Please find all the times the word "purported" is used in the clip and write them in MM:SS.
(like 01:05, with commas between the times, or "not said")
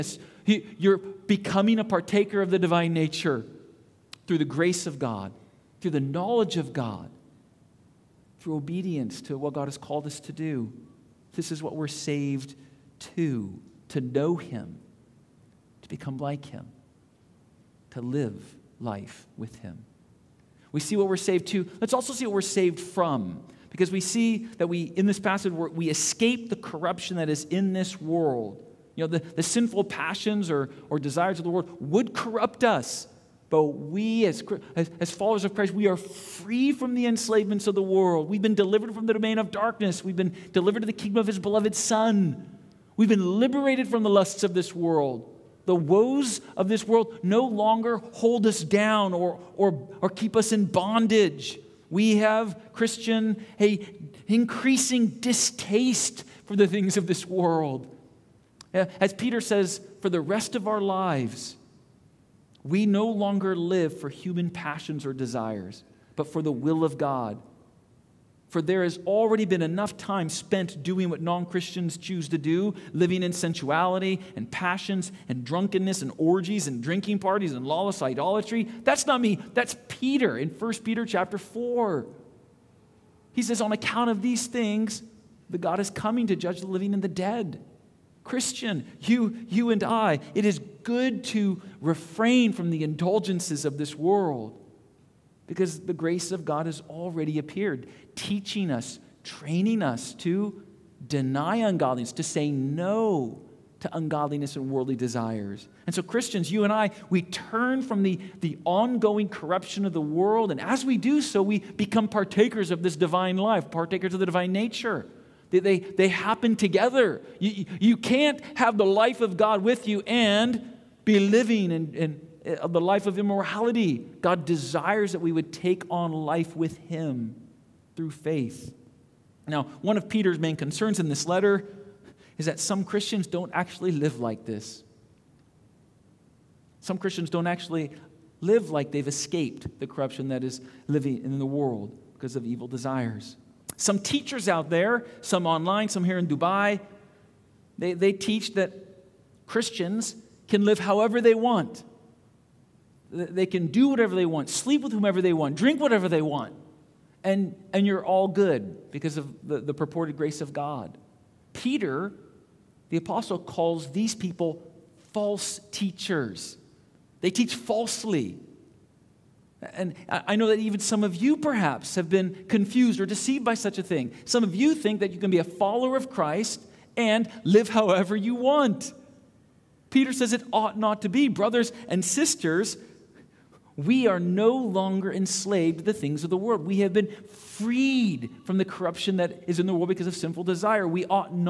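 02:39.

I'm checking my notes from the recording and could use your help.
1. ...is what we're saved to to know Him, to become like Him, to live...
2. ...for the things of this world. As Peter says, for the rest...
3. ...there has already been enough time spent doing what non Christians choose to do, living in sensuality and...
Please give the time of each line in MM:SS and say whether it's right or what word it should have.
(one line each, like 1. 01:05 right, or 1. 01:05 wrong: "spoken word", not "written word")
1. 00:11 right
2. 00:56 right
3. 01:08 right.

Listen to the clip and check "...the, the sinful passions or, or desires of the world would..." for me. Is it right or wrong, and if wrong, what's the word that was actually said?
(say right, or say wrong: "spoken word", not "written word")
right.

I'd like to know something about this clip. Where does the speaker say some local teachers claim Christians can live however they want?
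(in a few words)
Dubai.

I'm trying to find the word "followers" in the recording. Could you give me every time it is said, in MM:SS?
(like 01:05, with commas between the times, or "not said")
00:35, 02:55.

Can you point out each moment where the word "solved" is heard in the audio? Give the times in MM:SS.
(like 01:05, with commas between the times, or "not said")
not said.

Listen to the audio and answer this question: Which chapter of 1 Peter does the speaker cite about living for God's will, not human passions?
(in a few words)
Chapter 4.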